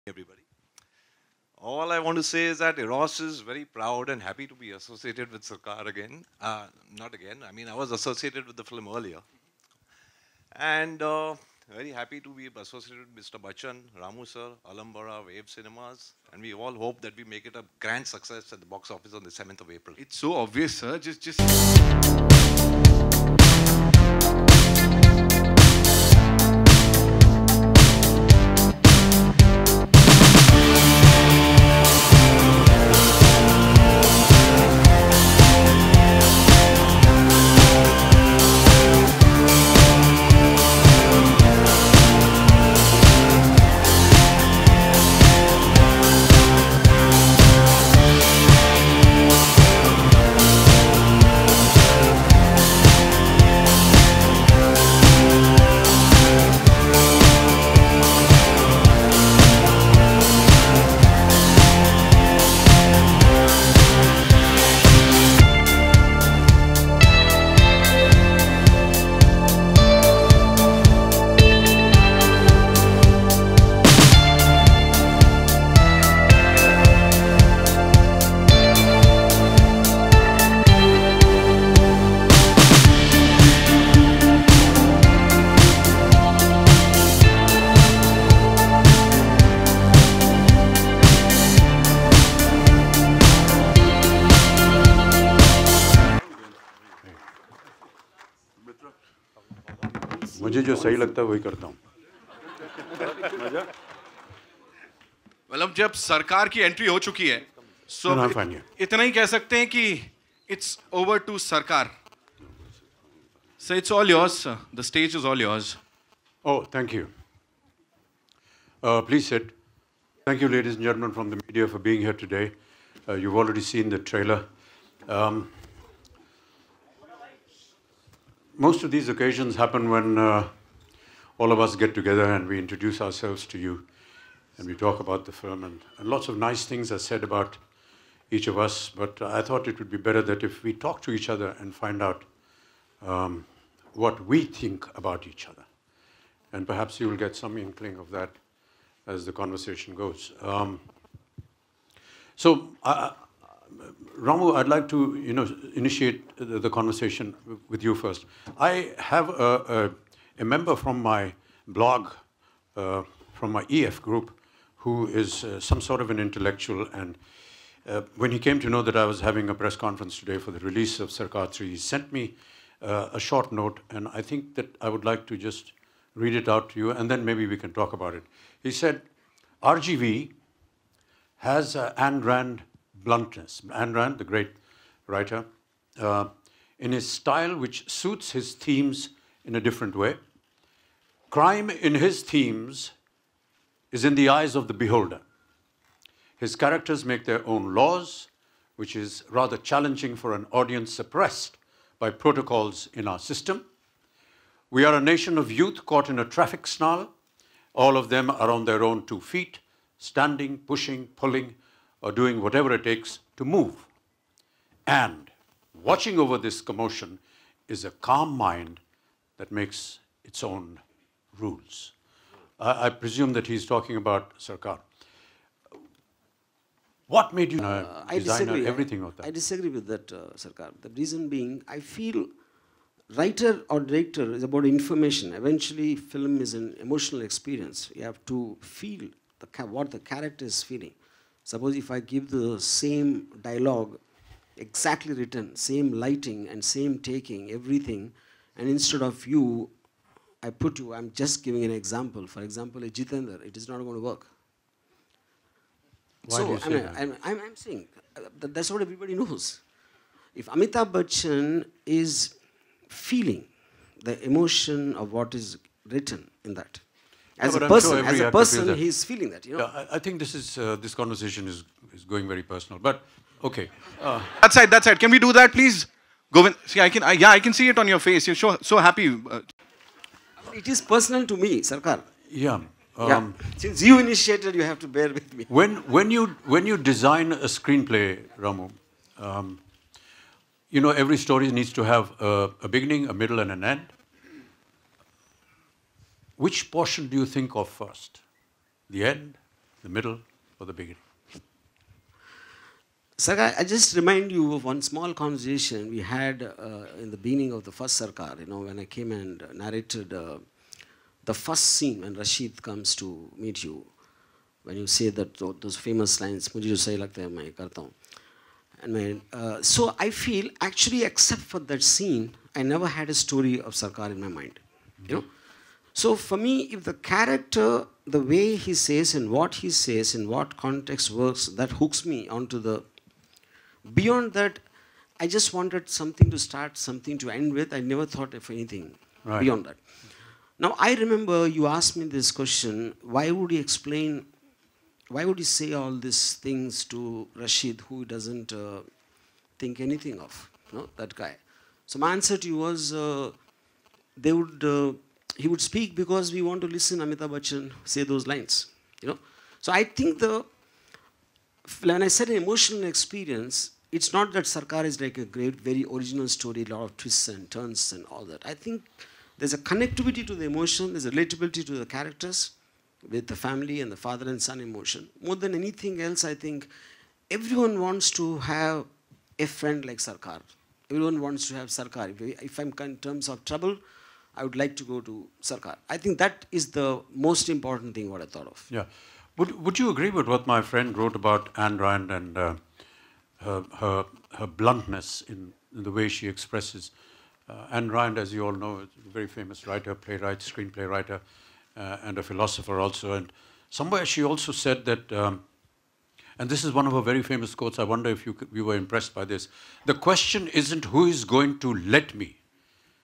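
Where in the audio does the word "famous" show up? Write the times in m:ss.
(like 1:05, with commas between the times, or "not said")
5:15, 6:39, 6:47.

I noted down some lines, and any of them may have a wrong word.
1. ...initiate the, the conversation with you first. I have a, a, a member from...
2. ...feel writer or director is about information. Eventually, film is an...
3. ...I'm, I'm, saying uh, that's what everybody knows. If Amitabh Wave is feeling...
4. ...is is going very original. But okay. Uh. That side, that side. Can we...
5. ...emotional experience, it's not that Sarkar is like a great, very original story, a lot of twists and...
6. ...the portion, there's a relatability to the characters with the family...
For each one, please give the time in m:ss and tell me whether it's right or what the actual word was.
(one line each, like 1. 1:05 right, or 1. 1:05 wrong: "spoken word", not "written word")
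1. 2:35 right
2. 3:51 right
3. 4:17 wrong: "Bachchan", not "Wave"
4. 4:31 wrong: "personal", not "original"
5. 6:02 right
6. 6:10 wrong: "emotion", not "portion".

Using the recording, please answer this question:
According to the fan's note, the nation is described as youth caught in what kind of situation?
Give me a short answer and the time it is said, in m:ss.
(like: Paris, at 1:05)
traffic snarl, at 3:26.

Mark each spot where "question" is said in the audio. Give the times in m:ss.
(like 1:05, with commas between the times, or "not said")
5:42, 6:49.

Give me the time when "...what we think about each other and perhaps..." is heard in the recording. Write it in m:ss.
2:23.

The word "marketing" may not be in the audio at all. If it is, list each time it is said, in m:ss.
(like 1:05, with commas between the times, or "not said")
not said.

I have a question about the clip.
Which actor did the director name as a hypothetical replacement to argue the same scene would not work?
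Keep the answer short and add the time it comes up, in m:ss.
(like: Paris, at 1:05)
Jitendra, at 4:12.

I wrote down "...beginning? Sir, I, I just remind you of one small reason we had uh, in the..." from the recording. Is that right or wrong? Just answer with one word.
wrong.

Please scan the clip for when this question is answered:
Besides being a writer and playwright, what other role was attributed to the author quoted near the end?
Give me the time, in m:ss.
6:42.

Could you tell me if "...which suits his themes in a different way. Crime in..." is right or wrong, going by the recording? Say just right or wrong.
right.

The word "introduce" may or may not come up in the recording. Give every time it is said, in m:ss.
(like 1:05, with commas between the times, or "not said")
2:12.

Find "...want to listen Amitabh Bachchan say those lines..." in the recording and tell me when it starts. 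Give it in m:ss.
5:56.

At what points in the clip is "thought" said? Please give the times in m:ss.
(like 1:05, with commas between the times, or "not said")
2:19, 5:38, 6:28.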